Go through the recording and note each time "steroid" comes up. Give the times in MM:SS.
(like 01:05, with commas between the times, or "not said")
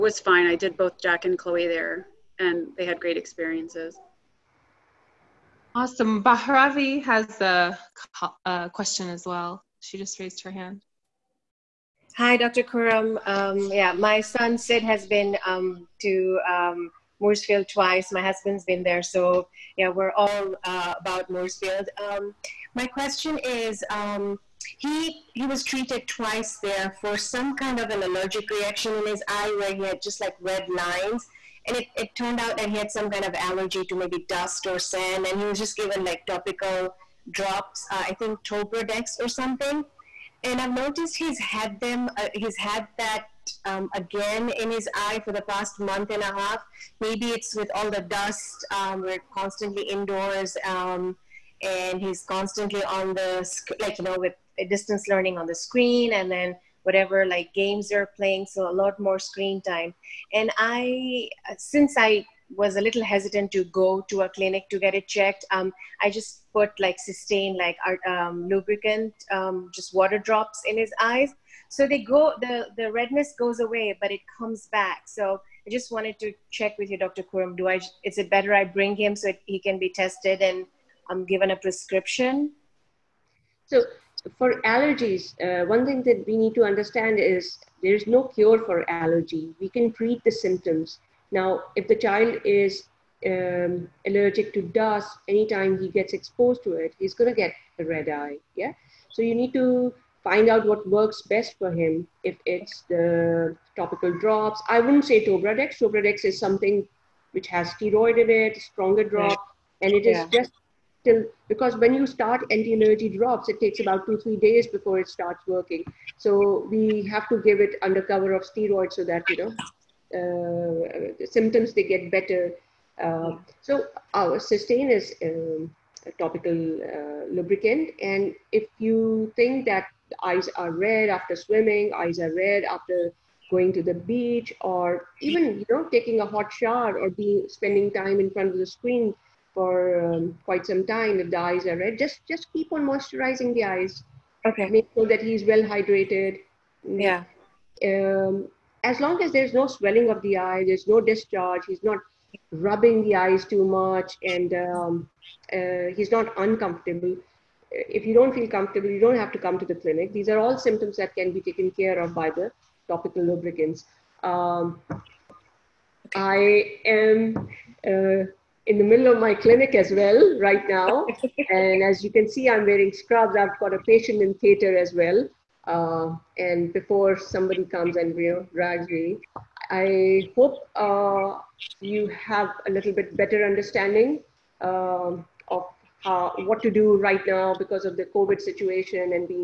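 01:47, 01:58.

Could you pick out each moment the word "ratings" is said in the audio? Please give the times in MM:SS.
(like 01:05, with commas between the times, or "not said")
not said.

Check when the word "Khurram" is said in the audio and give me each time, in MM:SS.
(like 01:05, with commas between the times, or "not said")
00:12, 01:17.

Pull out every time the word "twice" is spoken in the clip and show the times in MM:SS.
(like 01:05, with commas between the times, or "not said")
00:17, 00:26.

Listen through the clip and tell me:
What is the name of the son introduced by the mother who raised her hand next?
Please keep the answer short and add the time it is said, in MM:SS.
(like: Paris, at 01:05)
Sid, at 00:14.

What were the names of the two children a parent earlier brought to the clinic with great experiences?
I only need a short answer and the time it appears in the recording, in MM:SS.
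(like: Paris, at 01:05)
Jack and Chloe, at 00:01.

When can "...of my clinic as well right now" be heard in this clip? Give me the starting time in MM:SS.
02:49.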